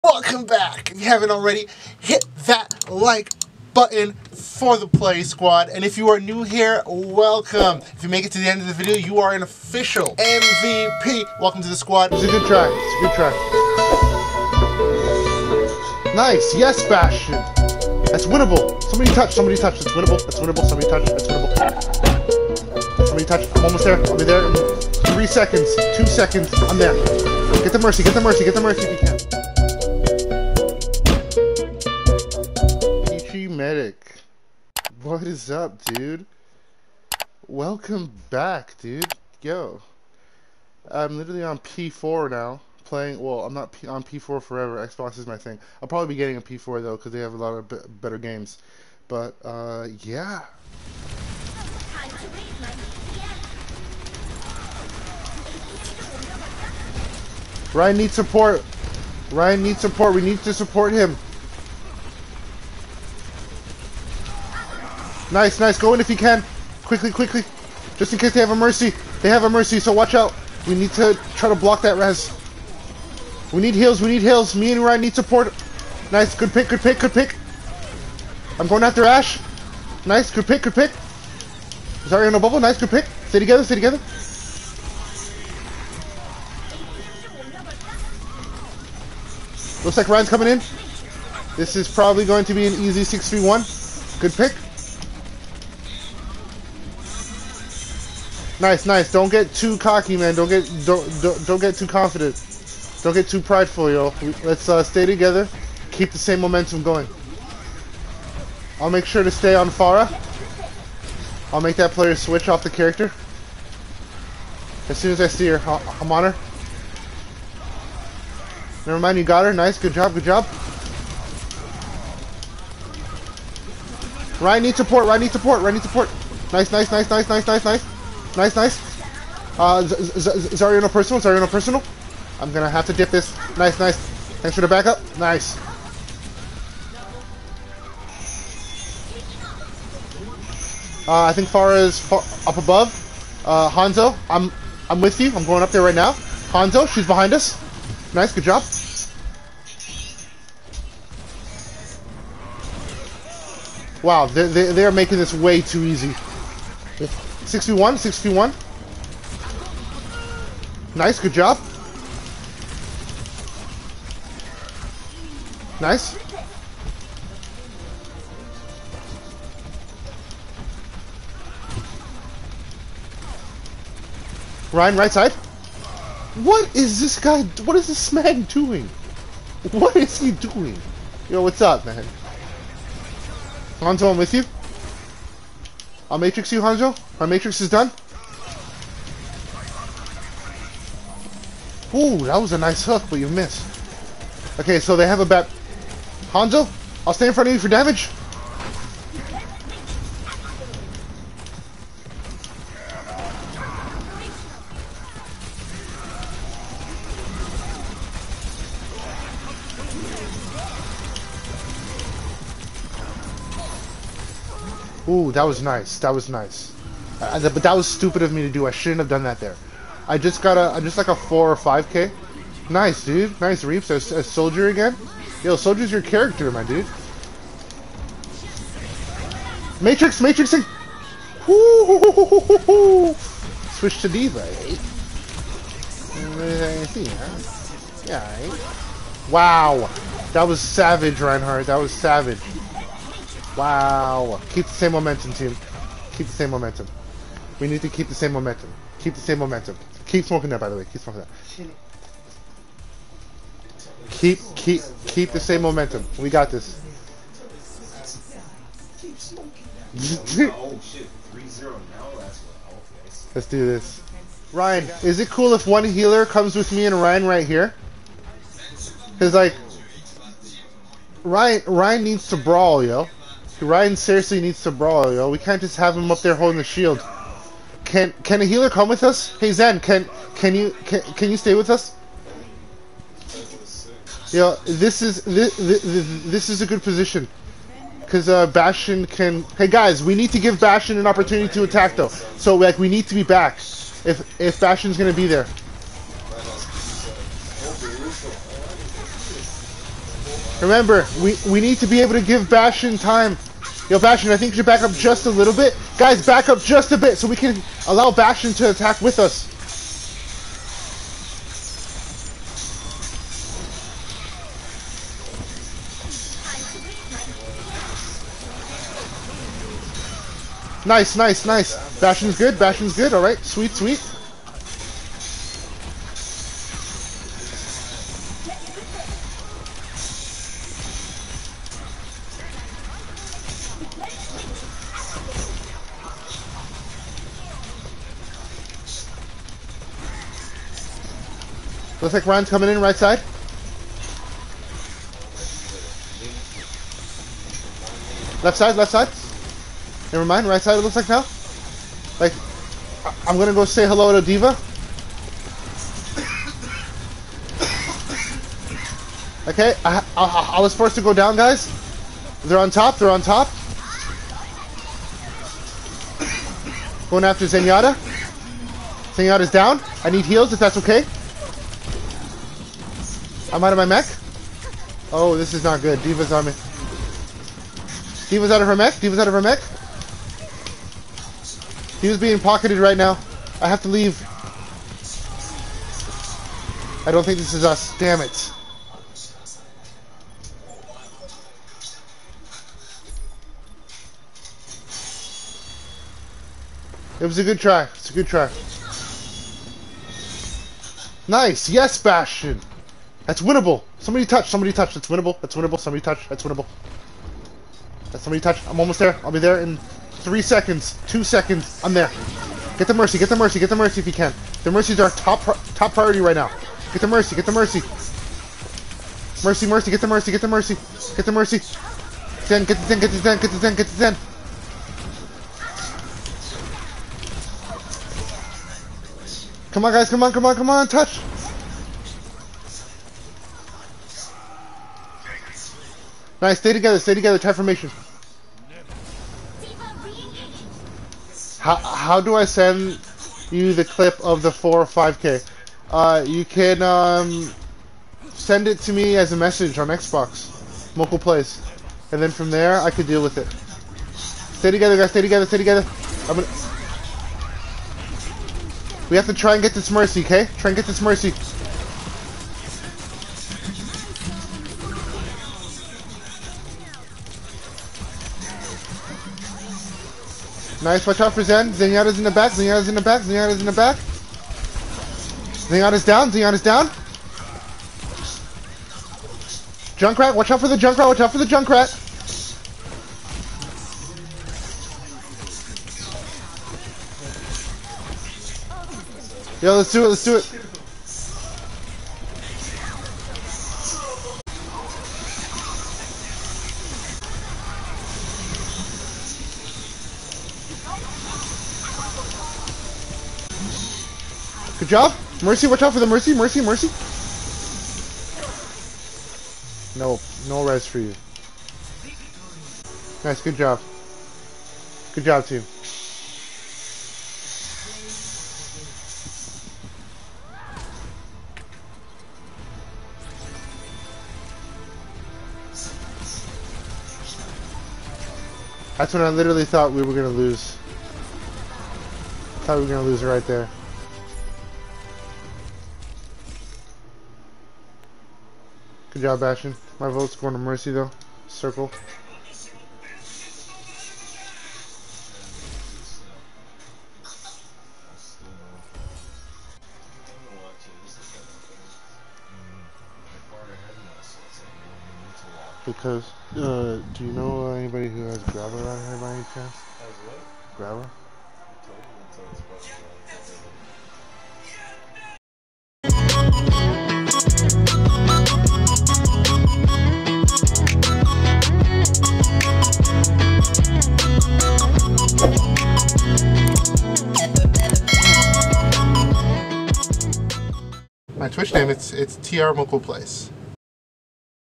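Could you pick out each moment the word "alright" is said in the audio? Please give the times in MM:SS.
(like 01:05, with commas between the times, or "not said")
05:23.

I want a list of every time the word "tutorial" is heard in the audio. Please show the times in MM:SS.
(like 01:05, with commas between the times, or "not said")
not said.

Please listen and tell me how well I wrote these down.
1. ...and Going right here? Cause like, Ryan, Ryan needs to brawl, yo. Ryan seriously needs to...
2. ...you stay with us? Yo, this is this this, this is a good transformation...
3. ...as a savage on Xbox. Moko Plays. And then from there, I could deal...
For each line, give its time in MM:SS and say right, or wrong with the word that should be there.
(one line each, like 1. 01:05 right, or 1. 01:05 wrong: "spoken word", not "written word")
1. 04:26 wrong: "Ryan", not "Going"
2. 04:41 wrong: "position", not "transformation"
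3. 07:29 wrong: "message", not "savage".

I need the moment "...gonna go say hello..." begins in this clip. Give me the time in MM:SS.
05:53.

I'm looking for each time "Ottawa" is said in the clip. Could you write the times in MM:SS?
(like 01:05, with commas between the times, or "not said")
not said.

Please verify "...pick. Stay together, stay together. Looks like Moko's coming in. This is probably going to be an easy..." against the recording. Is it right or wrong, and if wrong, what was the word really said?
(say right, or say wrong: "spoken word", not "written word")
wrong: "Ryan", not "Moko".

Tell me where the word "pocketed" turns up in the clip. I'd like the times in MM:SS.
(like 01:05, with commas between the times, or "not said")
06:22.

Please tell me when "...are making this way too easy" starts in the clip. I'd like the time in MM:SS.
02:34.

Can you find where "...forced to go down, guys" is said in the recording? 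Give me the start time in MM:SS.
06:00.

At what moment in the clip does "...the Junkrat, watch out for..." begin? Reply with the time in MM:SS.
08:00.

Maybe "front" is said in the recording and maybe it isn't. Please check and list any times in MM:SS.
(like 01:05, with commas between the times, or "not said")
03:17.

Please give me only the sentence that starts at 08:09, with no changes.
Yo, let's do it, let's do it.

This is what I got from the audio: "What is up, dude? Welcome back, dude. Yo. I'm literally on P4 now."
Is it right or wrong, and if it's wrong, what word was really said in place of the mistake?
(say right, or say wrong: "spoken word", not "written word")
right.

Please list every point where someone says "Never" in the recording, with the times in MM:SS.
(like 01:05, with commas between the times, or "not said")
01:58, 05:50.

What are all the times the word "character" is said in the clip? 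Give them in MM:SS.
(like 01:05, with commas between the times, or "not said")
01:52, 03:46.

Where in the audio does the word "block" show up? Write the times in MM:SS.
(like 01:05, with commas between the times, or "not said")
01:11.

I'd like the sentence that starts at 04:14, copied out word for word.
Keep, keep, keep the same momentum.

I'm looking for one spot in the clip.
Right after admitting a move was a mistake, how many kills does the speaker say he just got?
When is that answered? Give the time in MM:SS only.
03:41.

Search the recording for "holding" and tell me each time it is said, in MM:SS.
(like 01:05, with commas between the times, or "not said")
04:36.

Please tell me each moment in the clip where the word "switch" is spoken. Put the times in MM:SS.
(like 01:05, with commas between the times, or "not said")
01:52, 03:53.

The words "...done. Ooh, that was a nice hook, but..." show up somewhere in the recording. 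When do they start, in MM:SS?
03:07.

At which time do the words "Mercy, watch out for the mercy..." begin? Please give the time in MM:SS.
08:25.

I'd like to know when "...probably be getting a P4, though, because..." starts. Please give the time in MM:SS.
00:45.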